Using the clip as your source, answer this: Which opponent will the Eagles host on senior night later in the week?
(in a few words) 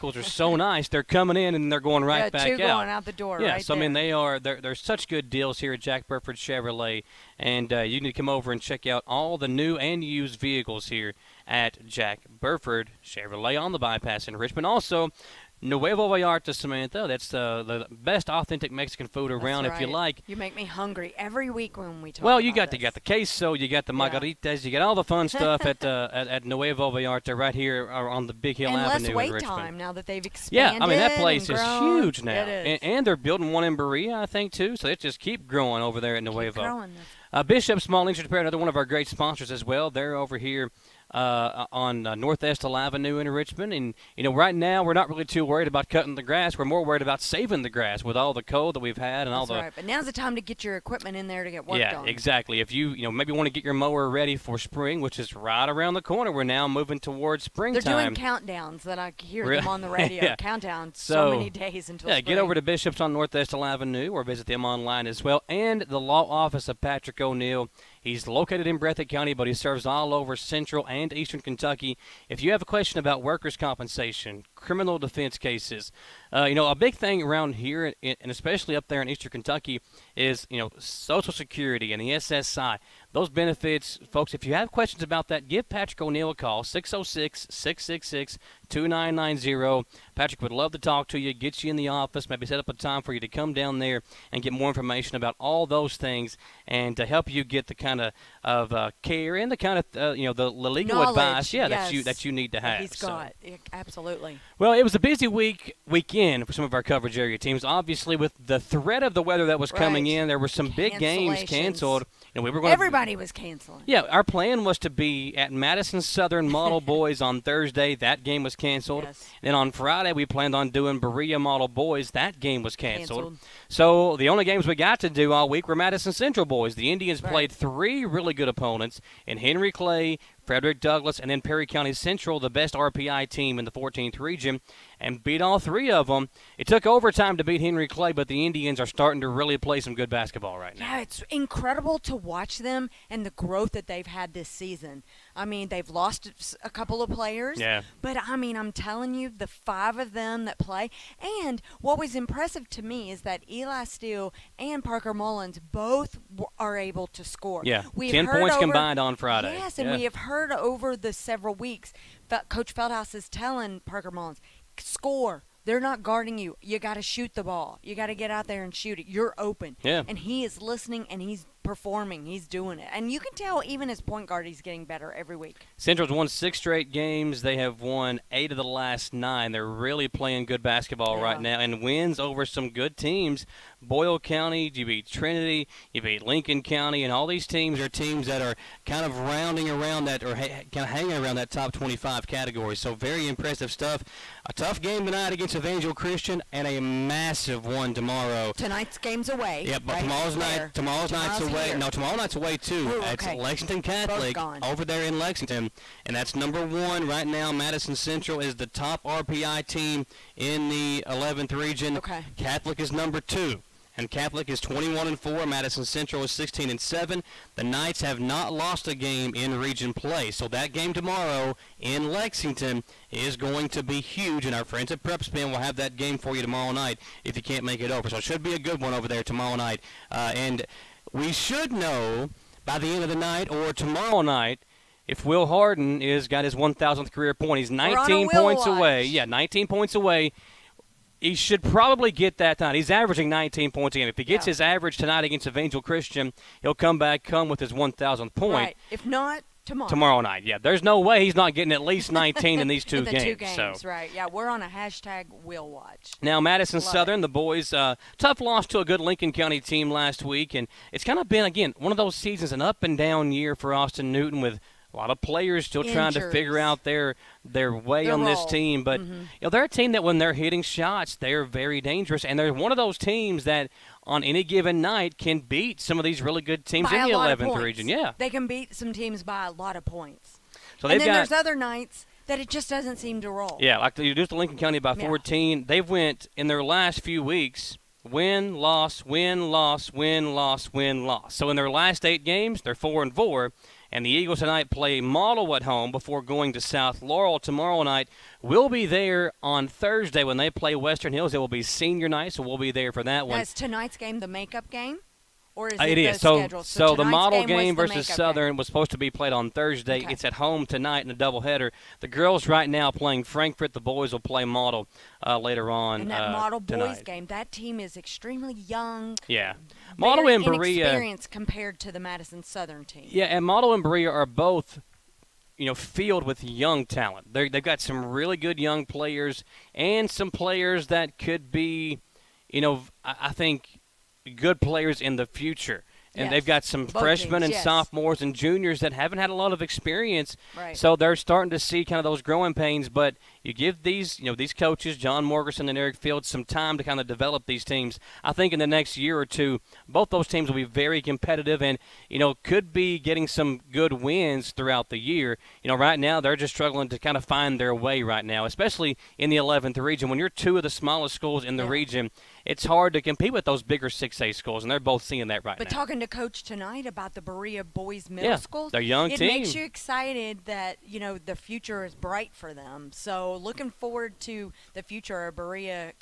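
Western Hills.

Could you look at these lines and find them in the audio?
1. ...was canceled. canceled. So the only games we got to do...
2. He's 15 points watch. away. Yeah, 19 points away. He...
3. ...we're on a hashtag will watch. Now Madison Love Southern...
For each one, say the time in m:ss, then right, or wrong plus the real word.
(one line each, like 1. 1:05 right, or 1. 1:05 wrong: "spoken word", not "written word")
1. 2:02 right
2. 3:57 wrong: "19", not "15"
3. 4:14 right.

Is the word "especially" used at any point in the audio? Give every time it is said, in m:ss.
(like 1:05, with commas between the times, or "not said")
1:18, 5:58.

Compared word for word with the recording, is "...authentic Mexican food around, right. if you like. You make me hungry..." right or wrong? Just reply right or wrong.
right.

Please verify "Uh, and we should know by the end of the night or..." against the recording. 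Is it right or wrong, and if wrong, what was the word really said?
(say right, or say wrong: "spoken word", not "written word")
right.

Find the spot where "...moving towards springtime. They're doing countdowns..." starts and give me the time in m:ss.
0:56.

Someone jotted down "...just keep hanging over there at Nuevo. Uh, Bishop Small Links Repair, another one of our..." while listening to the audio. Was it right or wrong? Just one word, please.
wrong.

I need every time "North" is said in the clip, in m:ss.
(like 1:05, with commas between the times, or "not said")
0:42, 1:03.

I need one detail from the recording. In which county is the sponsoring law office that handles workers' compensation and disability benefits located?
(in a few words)
Breathitt County.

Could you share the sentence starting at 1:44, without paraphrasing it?
Well, it was a busy week weekend for some of our coverage area teams.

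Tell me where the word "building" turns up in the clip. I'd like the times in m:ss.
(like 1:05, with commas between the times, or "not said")
0:33.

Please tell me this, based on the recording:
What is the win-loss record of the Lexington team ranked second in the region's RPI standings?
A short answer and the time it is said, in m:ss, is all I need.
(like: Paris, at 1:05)
21-4, at 3:34.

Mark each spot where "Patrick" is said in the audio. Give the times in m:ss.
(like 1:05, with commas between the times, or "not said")
1:06, 1:25, 1:30.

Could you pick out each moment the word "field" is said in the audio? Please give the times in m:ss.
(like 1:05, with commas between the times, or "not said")
5:25, 5:45.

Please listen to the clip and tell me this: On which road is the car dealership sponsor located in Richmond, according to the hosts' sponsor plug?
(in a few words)
the bypass.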